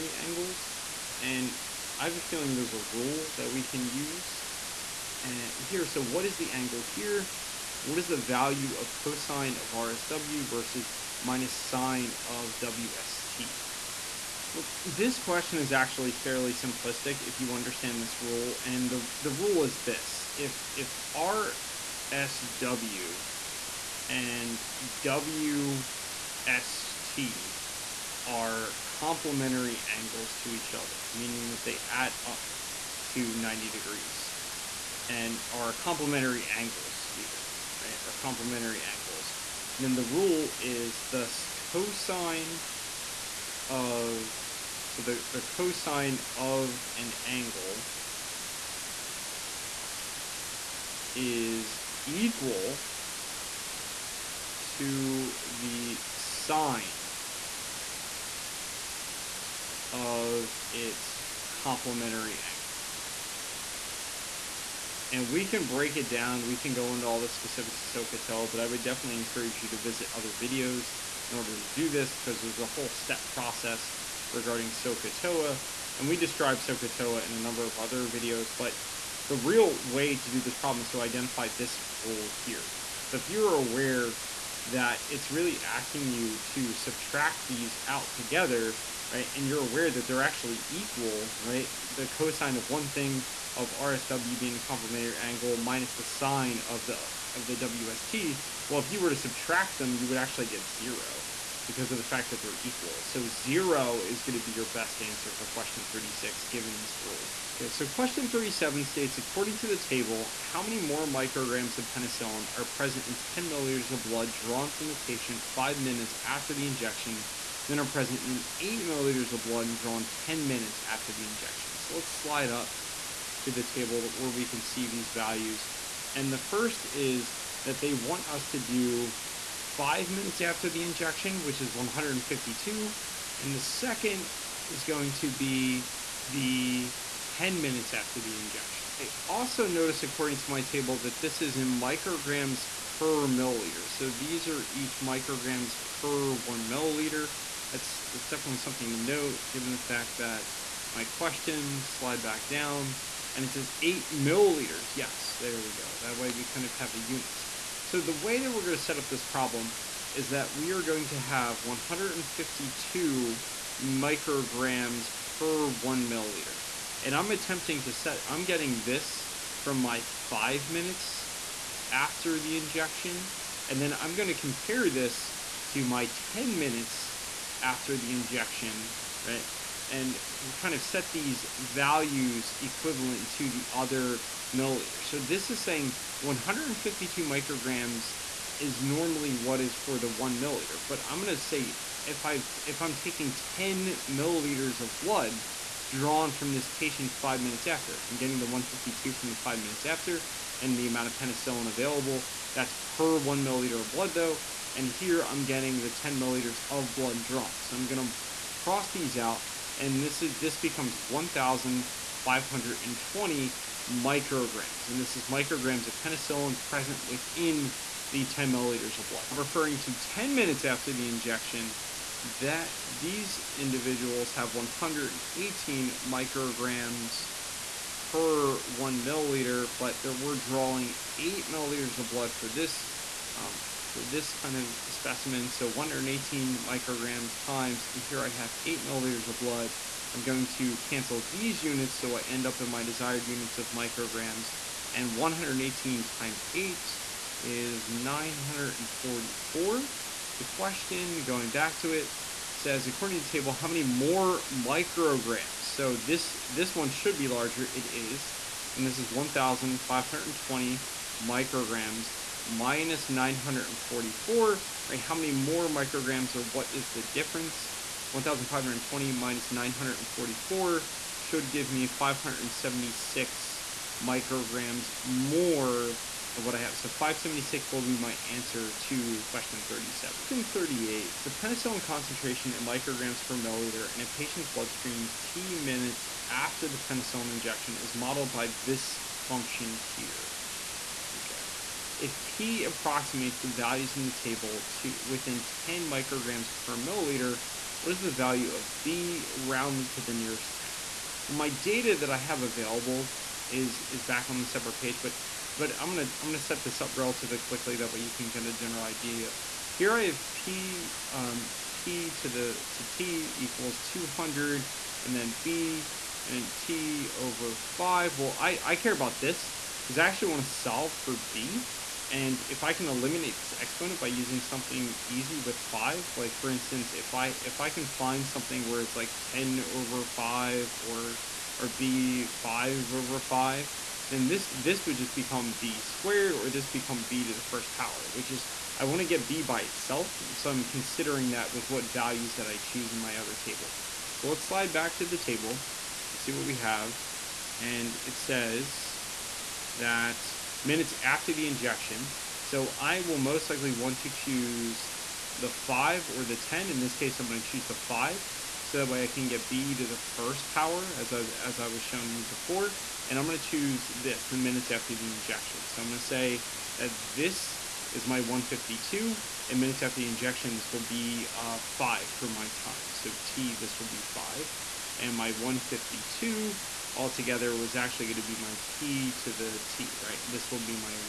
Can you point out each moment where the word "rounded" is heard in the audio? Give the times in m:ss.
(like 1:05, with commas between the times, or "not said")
4:59.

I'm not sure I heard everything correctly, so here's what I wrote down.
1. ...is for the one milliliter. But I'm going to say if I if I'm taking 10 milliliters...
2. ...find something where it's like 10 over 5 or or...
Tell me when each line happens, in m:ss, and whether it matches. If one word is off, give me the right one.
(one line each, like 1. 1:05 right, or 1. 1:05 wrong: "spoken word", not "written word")
1. 3:09 right
2. 5:27 right.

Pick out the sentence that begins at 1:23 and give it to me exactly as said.
So if you're aware that it's really asking you to subtract these out together right?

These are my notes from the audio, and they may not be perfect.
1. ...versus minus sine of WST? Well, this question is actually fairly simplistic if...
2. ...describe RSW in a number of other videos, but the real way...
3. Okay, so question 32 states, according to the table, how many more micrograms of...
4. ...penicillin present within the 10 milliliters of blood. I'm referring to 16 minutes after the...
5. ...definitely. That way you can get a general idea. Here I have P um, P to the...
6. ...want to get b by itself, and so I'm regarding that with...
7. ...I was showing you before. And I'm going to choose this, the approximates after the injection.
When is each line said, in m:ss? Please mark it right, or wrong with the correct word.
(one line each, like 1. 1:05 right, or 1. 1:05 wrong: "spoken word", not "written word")
1. 0:10 right
2. 1:16 wrong: "SoCaToa", not "RSW"
3. 1:47 wrong: "37", not "32"
4. 3:36 wrong: "10", not "16"
5. 5:07 wrong: "quickly", not "definitely"
6. 5:38 wrong: "considering", not "regarding"
7. 6:01 wrong: "minutes", not "approximates".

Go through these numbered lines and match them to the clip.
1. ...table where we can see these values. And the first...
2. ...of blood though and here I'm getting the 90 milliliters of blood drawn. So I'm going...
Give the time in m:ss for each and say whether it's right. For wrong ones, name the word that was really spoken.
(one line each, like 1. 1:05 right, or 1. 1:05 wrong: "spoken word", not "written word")
1. 2:03 right
2. 3:23 wrong: "10", not "90".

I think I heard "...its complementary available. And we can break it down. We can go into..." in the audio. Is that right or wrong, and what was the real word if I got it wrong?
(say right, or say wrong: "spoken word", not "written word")
wrong: "angle", not "available".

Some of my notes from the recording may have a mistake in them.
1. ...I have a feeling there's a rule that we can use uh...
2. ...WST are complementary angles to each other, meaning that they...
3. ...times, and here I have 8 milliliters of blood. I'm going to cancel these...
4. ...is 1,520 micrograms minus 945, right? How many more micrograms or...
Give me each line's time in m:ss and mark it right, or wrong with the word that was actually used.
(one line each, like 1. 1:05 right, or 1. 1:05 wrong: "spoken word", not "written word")
1. 0:01 right
2. 0:25 right
3. 3:57 right
4. 4:18 wrong: "944", not "945".